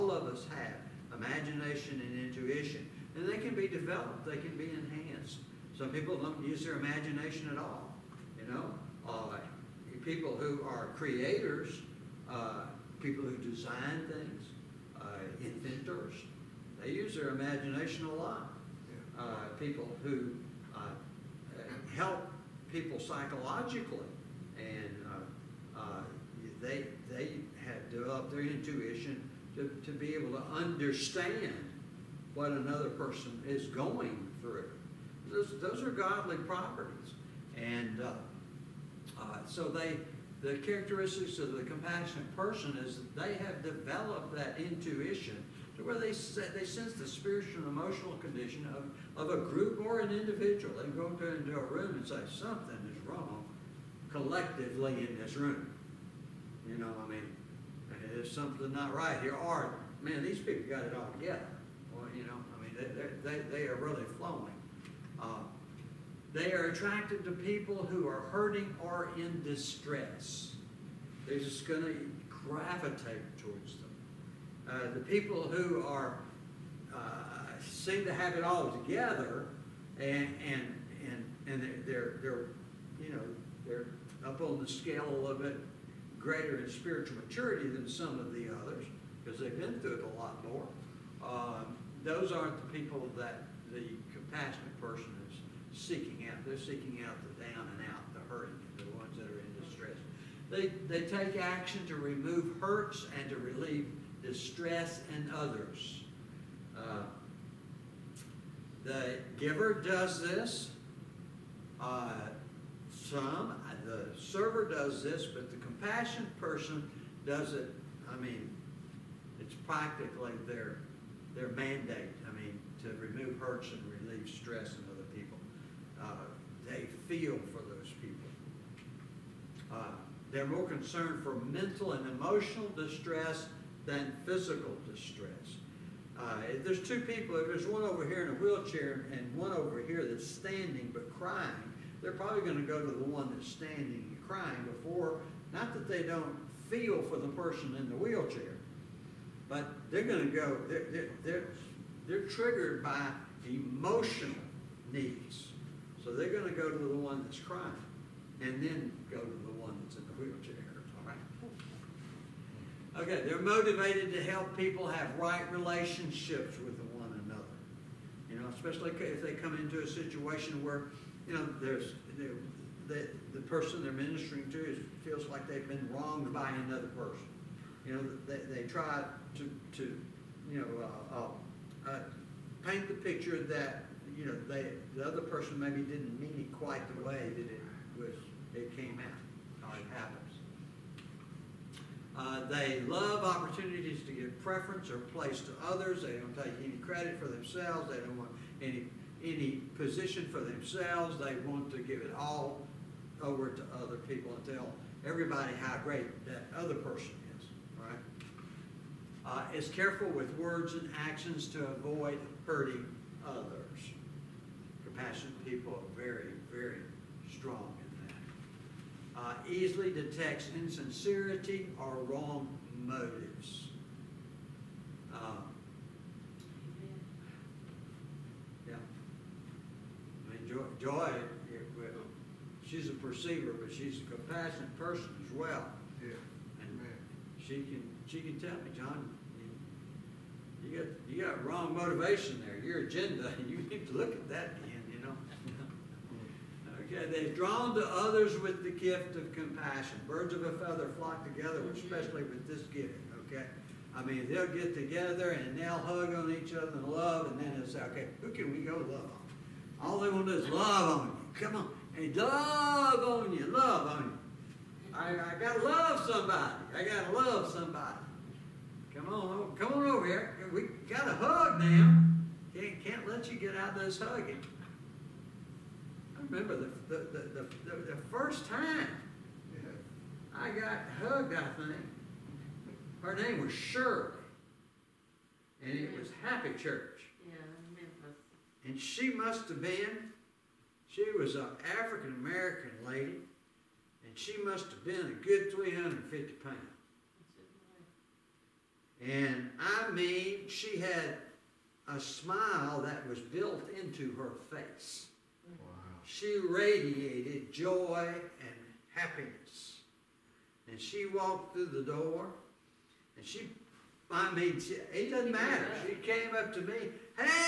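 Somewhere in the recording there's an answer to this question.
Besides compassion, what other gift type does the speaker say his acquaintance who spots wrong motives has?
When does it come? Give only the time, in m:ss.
3:52.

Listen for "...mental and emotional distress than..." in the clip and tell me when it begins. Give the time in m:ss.
2:11.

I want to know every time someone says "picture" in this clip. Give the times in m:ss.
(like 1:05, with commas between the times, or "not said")
3:02.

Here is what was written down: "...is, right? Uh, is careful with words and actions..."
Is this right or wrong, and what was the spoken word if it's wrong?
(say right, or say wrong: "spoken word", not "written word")
right.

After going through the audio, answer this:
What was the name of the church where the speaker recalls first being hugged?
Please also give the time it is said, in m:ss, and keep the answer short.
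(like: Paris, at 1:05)
Happy Church, at 4:46.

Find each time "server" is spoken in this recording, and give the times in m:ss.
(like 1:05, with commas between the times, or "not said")
1:54.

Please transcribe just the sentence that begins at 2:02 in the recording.
I mean, to remove hurts and relieve stress in other people.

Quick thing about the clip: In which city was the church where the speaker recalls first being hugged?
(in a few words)
Memphis.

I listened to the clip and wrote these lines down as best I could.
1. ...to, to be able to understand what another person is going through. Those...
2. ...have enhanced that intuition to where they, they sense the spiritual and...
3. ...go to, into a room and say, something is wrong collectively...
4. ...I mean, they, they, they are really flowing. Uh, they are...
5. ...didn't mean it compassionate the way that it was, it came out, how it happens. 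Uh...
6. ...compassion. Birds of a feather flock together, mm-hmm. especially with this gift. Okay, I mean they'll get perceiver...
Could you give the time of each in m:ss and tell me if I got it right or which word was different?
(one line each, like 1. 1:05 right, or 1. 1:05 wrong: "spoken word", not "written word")
1. 0:29 right
2. 0:43 wrong: "developed", not "enhanced"
3. 0:50 right
4. 1:02 right
5. 3:05 wrong: "quite", not "compassionate"
6. 4:09 wrong: "together", not "perceiver".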